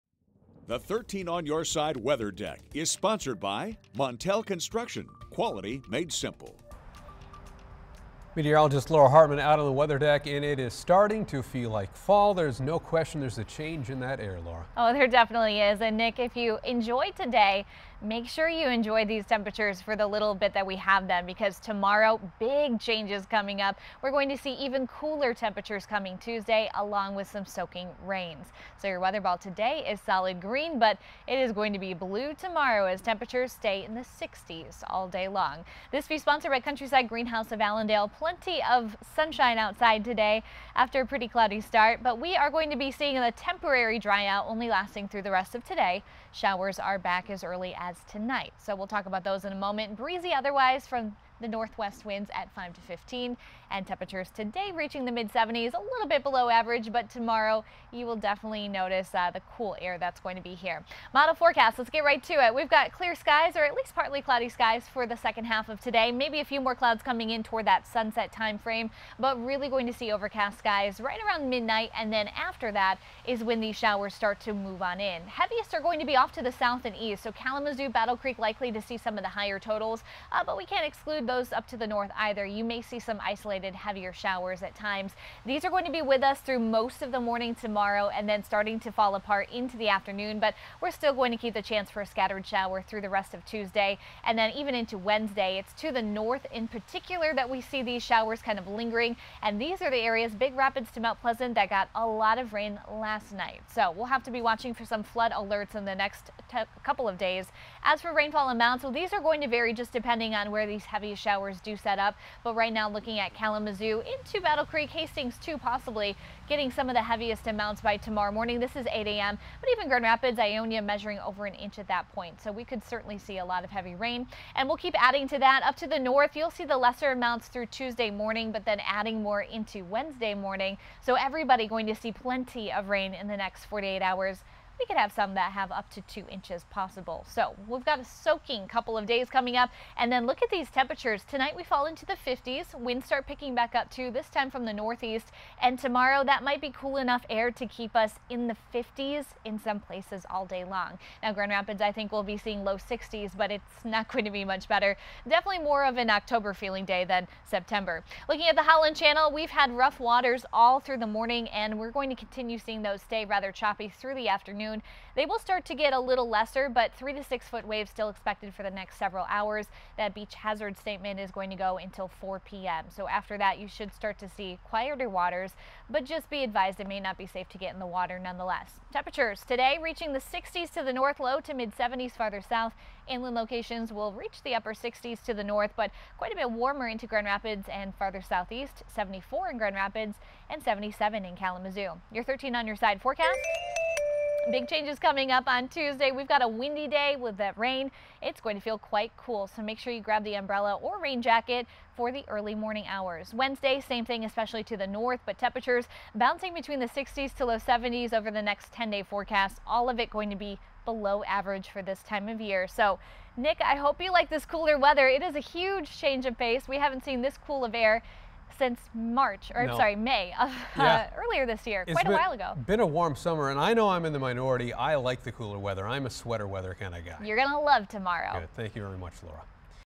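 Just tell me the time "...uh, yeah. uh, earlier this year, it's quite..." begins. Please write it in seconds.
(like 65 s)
220 s.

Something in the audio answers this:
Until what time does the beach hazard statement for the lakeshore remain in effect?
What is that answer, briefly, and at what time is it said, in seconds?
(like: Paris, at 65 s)
4 p.m., at 172 s.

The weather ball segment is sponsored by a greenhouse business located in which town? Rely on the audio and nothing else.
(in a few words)
Allendale.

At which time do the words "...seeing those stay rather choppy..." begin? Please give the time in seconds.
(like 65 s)
162 s.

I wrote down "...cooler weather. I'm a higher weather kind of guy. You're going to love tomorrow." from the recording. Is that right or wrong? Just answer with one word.
wrong.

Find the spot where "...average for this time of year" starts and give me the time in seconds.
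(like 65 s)
211 s.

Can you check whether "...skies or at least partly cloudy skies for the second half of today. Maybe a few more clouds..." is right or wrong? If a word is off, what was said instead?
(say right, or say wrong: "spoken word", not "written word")
right.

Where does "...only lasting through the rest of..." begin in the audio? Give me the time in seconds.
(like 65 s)
44 s.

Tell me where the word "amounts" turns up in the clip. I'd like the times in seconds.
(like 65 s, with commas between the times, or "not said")
108 s, 117 s, 127 s.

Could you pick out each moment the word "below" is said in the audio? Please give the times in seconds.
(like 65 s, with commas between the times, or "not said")
56 s, 210 s.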